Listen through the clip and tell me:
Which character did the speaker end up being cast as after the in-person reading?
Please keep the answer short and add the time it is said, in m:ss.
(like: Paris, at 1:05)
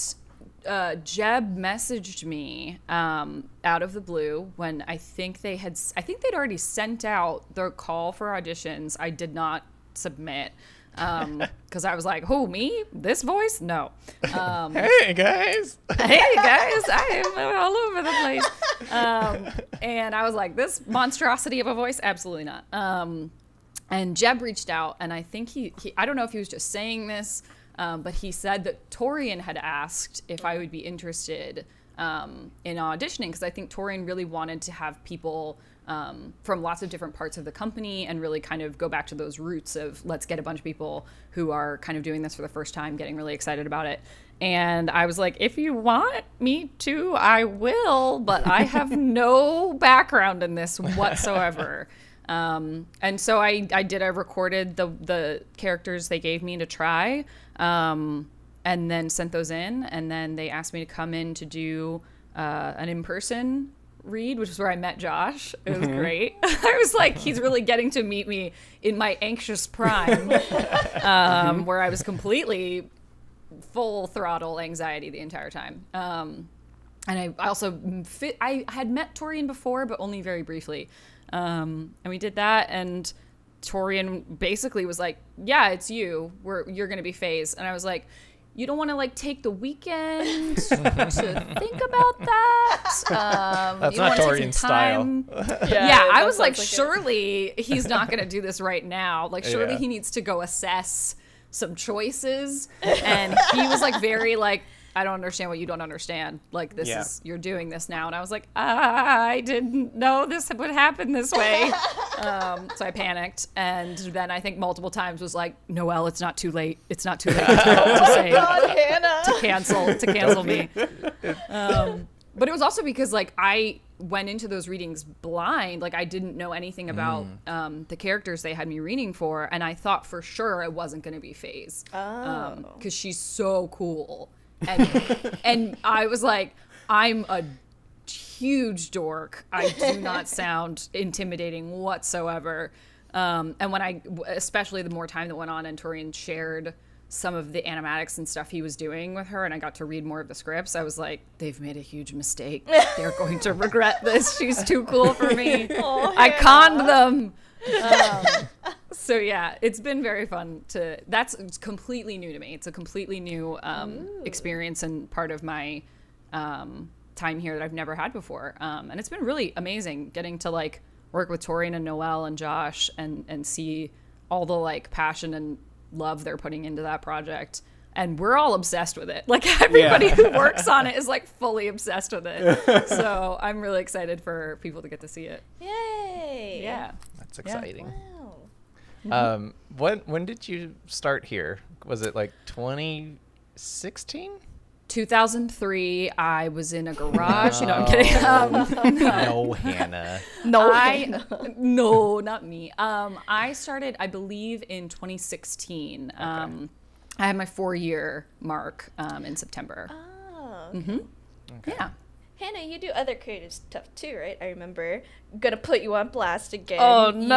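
Phase, at 1:27.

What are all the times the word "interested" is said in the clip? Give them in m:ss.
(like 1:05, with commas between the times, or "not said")
0:30.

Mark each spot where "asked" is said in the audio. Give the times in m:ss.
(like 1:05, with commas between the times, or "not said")
0:29, 1:00.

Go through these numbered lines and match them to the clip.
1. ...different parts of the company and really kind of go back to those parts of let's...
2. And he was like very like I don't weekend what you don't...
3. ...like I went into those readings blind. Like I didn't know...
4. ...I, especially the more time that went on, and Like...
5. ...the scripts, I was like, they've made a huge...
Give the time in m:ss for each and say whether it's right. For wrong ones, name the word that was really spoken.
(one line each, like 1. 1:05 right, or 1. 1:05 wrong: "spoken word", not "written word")
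1. 0:36 wrong: "roots", not "parts"
2. 1:42 wrong: "understand", not "weekend"
3. 2:03 right
4. 2:23 wrong: "Torrian", not "Like"
5. 2:30 right.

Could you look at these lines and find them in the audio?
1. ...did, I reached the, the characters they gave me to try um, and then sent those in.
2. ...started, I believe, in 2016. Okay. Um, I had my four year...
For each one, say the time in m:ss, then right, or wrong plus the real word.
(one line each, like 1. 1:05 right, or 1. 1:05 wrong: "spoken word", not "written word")
1. 0:53 wrong: "recorded", not "reached"
2. 3:23 right.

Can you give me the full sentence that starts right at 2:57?
And we're all obsessed with it.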